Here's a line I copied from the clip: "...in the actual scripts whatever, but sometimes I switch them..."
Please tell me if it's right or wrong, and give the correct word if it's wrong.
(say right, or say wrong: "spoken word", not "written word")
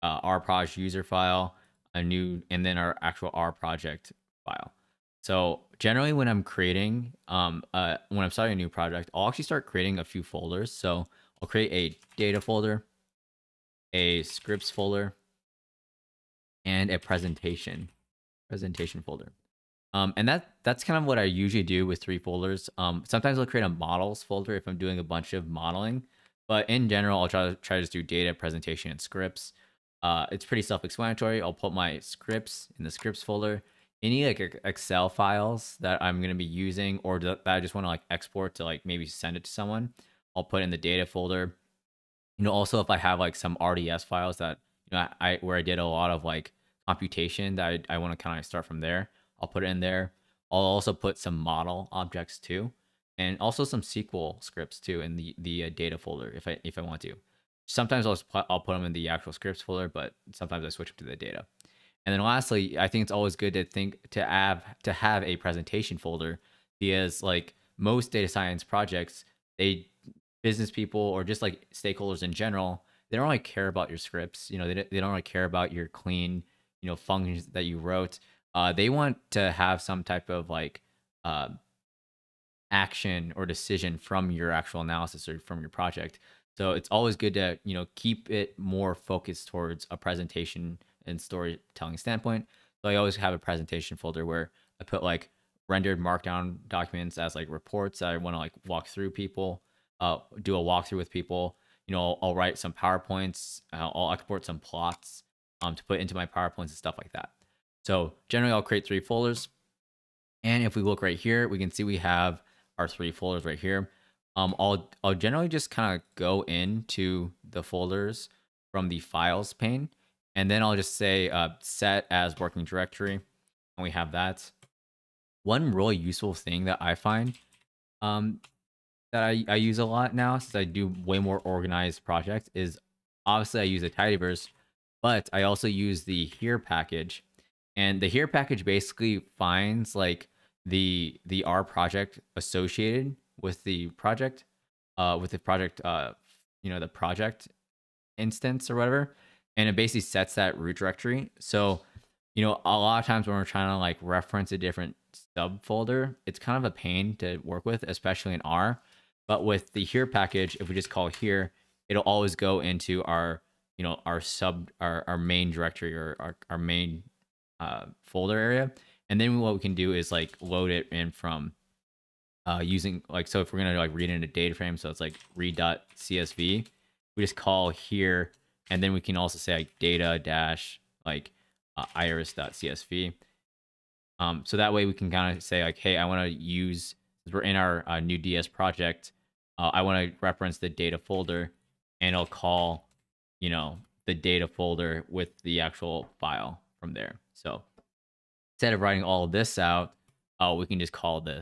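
wrong: "folder", not "whatever".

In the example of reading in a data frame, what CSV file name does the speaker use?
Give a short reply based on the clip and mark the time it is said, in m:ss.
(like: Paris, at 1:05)
iris.csv, at 3:01.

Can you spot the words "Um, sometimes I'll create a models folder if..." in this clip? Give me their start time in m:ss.
0:22.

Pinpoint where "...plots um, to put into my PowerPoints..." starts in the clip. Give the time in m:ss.
1:44.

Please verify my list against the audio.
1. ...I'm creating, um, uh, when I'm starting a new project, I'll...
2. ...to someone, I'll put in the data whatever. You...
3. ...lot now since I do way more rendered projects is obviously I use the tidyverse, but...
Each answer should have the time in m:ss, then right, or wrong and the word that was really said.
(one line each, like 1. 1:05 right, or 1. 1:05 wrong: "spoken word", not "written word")
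1. 0:06 right
2. 0:39 wrong: "folder", not "whatever"
3. 2:09 wrong: "organized", not "rendered".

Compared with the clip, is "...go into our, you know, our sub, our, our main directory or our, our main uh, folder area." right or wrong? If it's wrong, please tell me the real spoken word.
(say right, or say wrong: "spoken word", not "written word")
right.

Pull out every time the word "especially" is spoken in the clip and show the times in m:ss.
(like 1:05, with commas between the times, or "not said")
2:37.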